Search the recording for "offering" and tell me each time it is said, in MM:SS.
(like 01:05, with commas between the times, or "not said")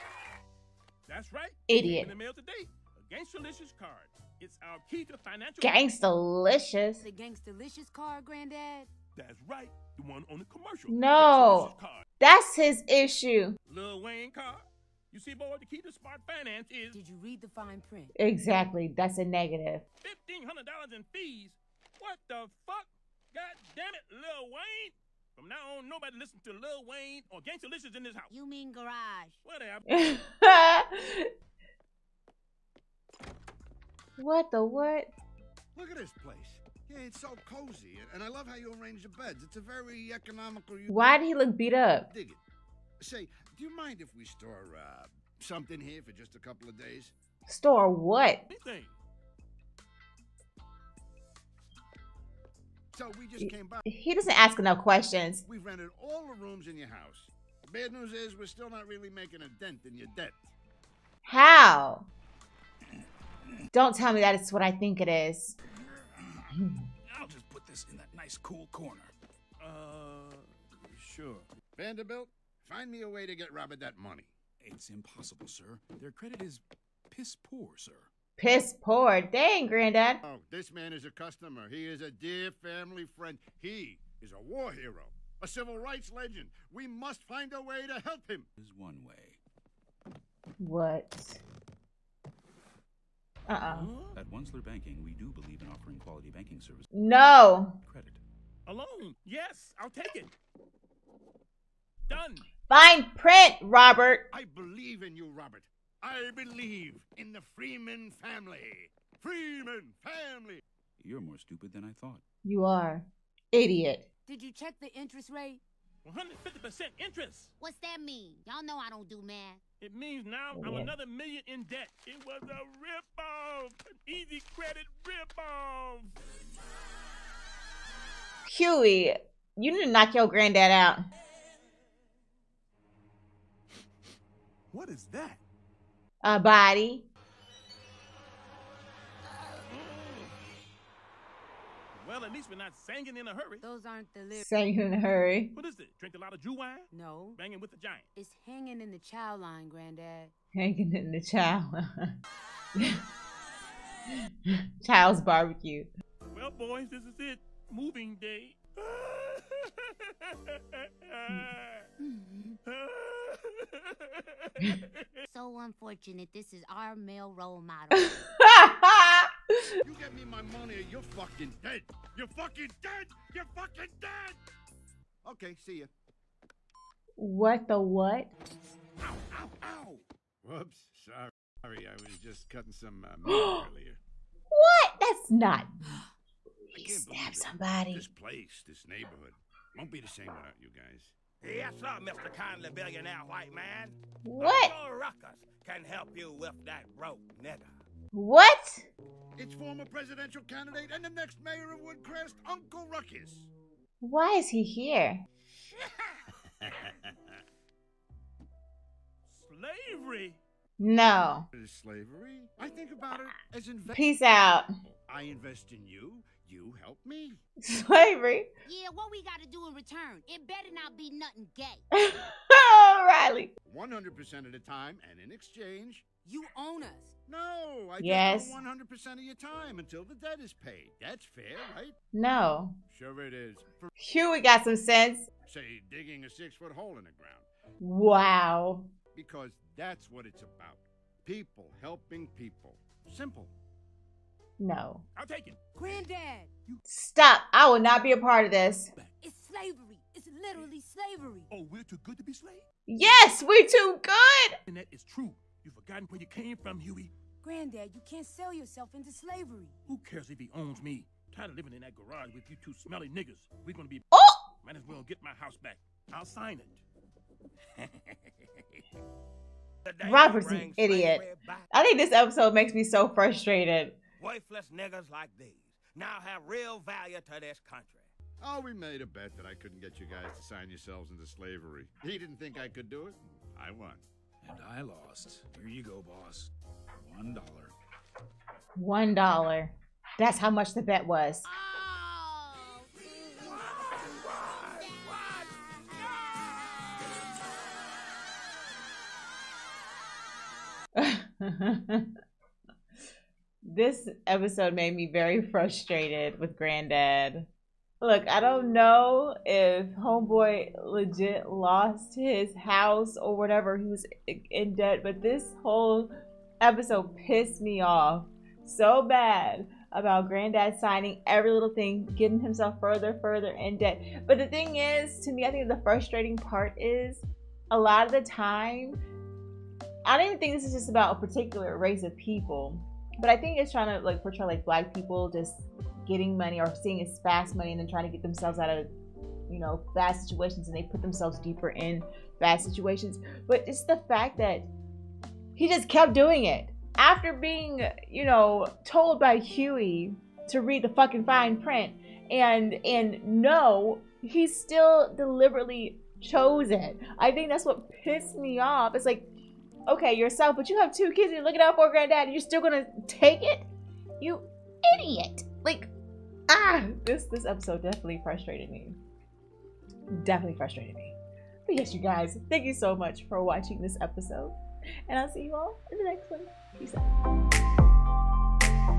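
01:35.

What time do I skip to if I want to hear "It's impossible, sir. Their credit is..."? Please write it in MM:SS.
01:14.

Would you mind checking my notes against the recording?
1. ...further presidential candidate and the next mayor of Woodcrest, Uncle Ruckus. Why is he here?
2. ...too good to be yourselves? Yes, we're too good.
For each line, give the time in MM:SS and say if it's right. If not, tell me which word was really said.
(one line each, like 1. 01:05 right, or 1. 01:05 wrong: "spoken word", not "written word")
1. 03:19 wrong: "former", not "further"
2. 04:11 wrong: "slaves", not "yourselves".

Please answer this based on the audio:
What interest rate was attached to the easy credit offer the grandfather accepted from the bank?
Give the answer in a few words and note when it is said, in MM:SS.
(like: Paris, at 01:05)
150%, at 01:56.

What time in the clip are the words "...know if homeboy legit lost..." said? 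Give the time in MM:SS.
05:08.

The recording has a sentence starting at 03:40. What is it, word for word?
It better not be nothing gay.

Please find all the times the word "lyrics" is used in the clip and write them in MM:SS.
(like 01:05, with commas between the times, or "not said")
02:24.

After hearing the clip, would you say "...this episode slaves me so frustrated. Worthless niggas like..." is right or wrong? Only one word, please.
wrong.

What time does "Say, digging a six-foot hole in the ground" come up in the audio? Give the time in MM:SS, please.
03:55.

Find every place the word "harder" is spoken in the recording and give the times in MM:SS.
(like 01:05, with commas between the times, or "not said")
not said.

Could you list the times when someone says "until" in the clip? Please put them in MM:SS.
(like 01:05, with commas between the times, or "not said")
03:49.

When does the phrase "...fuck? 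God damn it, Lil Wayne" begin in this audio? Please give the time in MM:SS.
00:22.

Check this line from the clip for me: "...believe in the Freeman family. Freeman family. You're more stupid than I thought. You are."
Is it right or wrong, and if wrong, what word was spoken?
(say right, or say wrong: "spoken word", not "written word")
right.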